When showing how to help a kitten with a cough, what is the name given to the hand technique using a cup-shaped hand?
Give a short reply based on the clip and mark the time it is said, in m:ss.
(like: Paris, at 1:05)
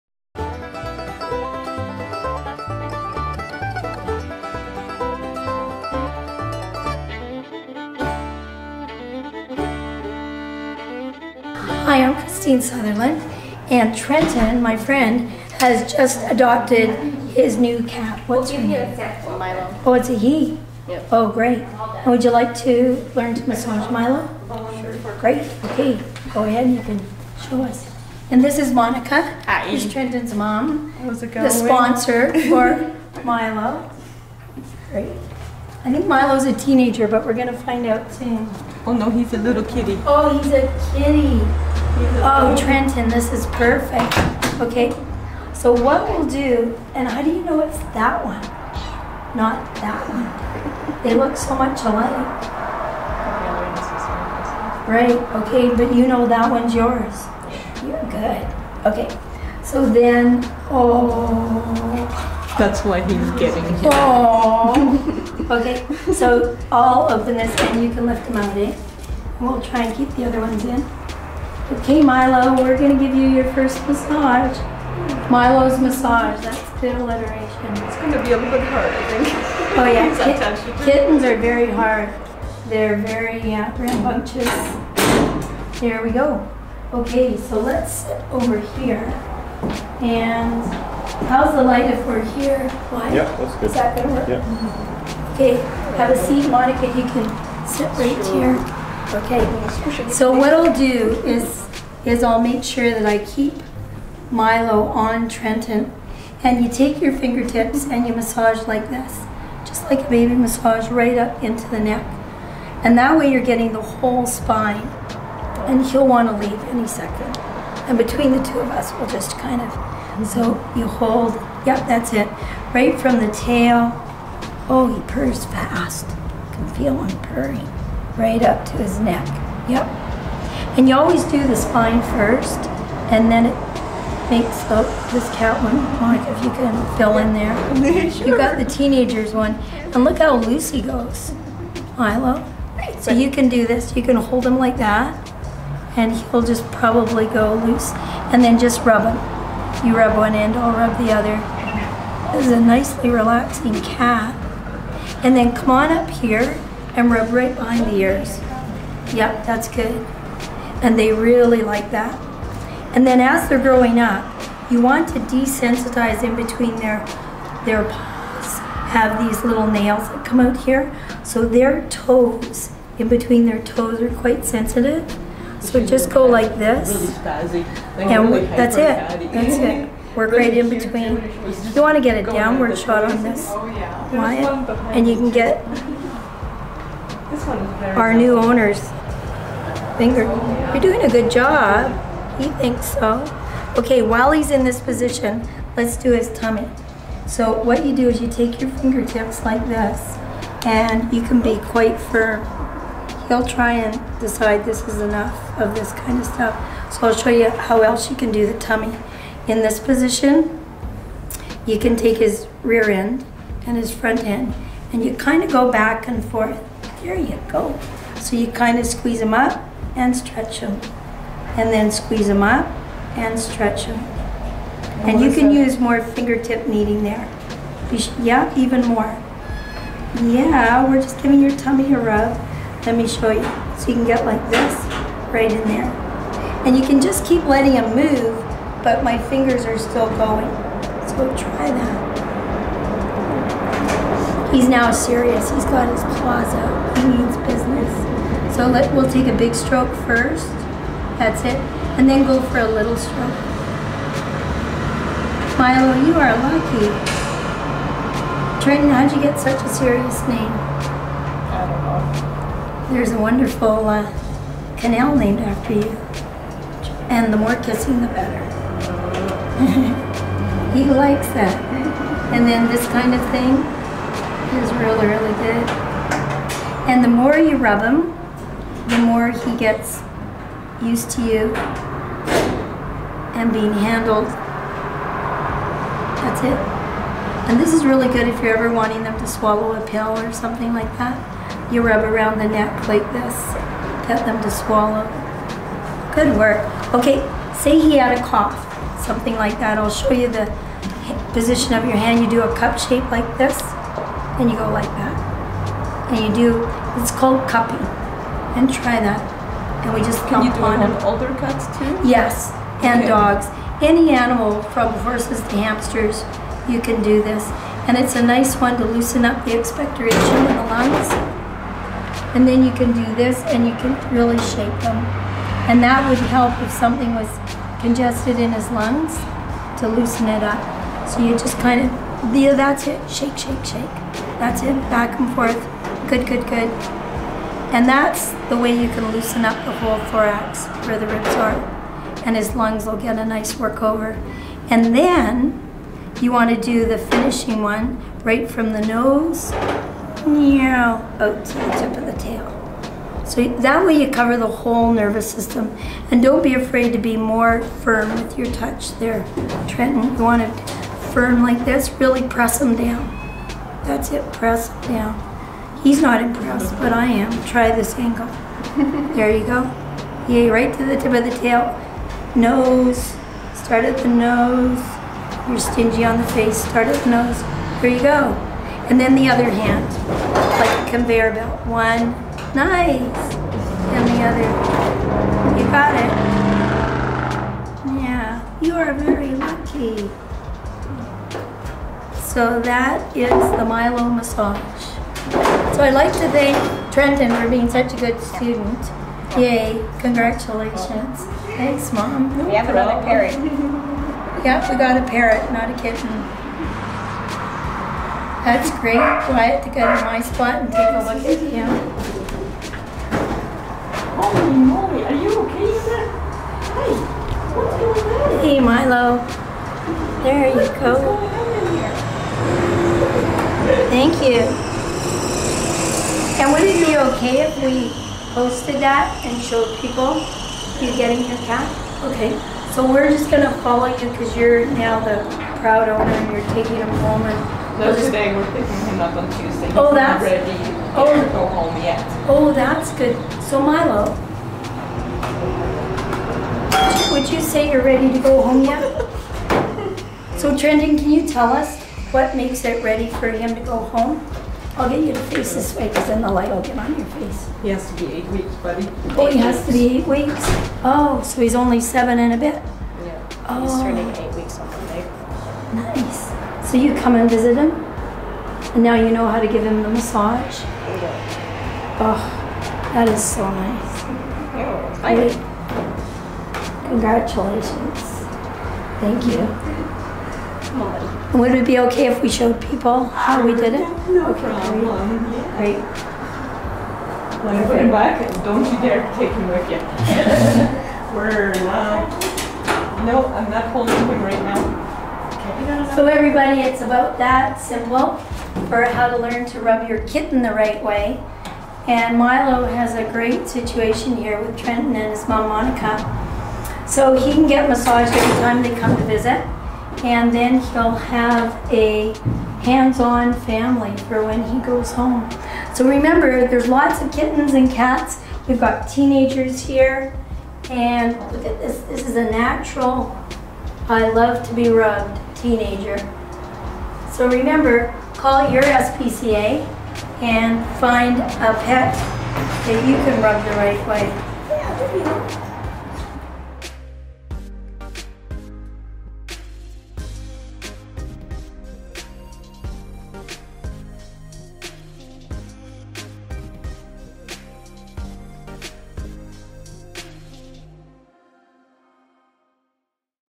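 Cupping, at 5:07.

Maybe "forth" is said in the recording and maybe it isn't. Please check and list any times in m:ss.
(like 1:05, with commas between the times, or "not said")
3:36, 5:35.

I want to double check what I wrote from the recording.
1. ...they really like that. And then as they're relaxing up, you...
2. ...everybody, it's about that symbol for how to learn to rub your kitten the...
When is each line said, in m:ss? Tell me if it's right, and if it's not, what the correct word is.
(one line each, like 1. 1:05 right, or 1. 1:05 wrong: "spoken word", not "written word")
1. 2:40 wrong: "growing", not "relaxing"
2. 8:16 right.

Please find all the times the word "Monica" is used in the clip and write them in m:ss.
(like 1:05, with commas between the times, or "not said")
0:28, 1:36, 2:15, 8:25.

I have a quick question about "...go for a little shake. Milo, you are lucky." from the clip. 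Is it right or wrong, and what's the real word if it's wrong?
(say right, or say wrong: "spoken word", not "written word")
wrong: "stroke", not "shake".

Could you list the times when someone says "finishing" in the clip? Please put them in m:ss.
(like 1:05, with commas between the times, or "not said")
5:46.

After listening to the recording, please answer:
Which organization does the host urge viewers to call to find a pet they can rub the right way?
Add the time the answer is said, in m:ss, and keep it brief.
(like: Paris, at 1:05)
SPCA, at 8:48.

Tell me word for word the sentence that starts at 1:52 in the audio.
And that way you're getting the whole spine.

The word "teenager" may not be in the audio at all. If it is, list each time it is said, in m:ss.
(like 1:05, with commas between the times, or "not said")
0:36, 2:18, 8:38, 8:45.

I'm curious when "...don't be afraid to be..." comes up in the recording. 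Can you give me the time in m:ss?
5:56.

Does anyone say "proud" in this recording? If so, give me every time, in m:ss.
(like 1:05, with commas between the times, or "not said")
7:15.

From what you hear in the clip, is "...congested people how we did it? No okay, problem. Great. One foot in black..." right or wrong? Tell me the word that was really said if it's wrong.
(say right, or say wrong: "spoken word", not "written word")
wrong: "showed", not "congested".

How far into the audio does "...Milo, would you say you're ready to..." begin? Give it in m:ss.
7:23.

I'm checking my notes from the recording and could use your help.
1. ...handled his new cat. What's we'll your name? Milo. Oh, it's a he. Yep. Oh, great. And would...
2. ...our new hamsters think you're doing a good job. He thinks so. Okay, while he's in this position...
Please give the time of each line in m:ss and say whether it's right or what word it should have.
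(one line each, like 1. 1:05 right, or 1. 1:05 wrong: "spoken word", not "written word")
1. 0:16 wrong: "adopted", not "handled"
2. 3:07 wrong: "owners", not "hamsters".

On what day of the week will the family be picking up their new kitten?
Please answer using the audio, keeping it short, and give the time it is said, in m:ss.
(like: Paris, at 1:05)
Tuesday, at 7:19.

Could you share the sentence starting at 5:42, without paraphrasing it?
And his lungs will get a nice workover.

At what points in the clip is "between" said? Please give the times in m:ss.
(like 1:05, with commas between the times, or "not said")
1:57, 2:46, 2:53, 3:00.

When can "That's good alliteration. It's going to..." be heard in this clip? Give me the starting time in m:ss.
1:16.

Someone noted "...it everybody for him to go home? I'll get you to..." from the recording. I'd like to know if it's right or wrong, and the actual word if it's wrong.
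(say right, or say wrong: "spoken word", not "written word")
wrong: "ready", not "everybody".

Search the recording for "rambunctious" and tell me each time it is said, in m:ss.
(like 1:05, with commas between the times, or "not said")
1:23.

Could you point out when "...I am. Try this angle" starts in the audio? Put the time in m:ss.
6:06.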